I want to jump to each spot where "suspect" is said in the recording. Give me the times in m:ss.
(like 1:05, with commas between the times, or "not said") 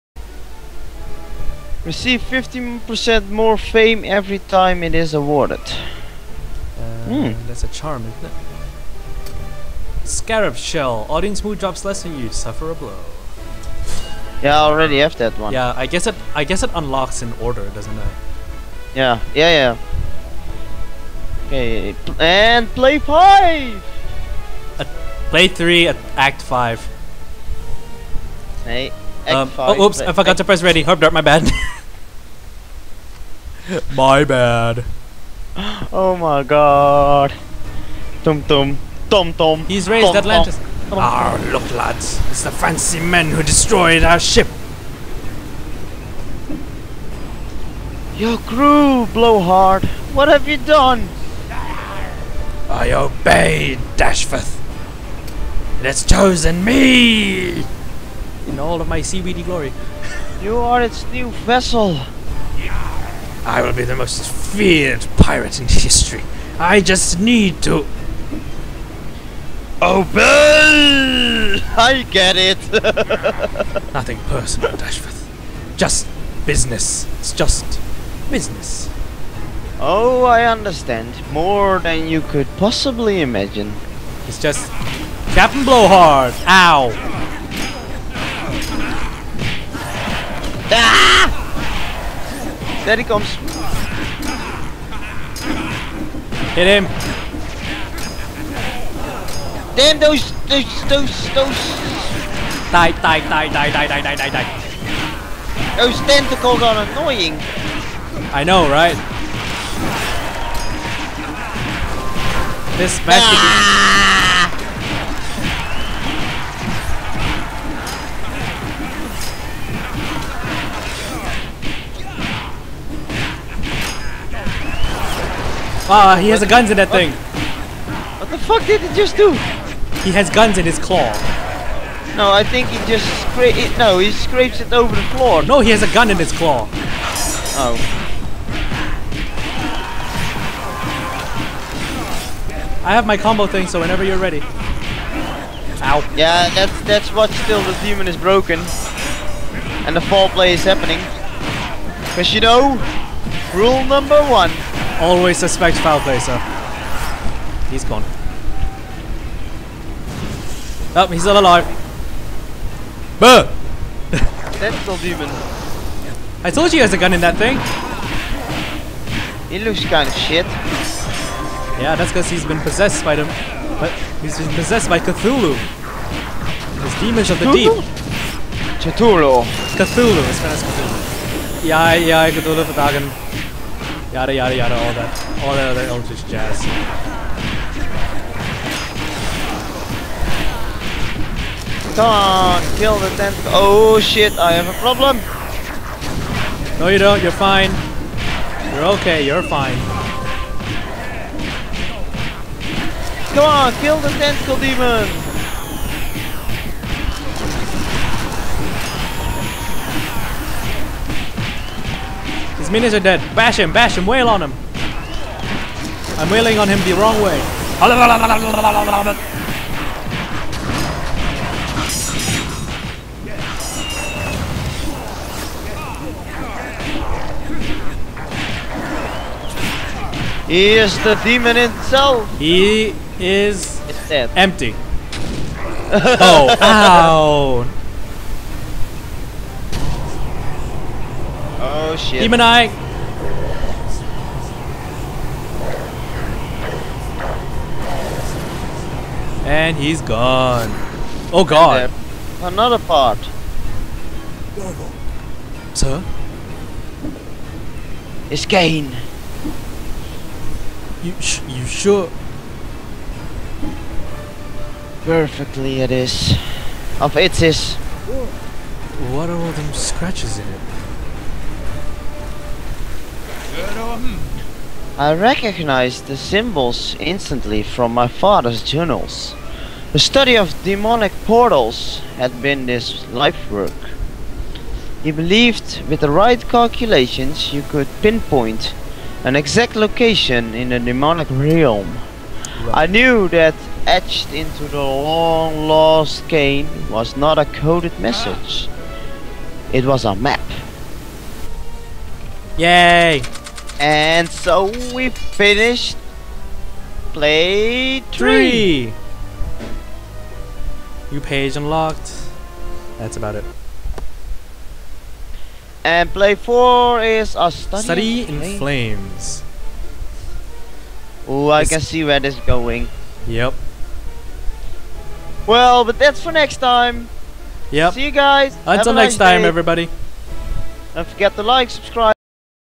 2:35.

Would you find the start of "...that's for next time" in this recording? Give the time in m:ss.
5:25.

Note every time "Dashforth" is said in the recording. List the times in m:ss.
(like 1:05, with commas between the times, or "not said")
0:53, 1:14.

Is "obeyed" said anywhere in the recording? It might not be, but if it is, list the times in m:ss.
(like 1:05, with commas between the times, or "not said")
0:52.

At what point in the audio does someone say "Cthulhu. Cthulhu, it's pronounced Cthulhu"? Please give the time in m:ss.
2:58.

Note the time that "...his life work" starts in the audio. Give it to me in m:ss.
4:42.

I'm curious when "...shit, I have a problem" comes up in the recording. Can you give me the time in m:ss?
3:14.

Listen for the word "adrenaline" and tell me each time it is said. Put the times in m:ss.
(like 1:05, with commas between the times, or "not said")
not said.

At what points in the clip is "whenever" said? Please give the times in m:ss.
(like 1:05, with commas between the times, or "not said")
2:23.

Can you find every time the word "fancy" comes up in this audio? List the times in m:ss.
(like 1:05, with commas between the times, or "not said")
0:42.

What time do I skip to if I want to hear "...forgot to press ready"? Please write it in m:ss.
0:30.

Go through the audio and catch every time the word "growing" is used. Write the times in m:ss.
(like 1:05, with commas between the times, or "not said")
not said.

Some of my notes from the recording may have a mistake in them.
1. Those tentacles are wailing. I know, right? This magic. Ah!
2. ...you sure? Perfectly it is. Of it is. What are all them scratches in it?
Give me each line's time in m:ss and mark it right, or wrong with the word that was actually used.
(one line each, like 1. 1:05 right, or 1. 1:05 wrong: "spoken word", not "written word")
1. 1:45 wrong: "annoying", not "wailing"
2. 4:21 right.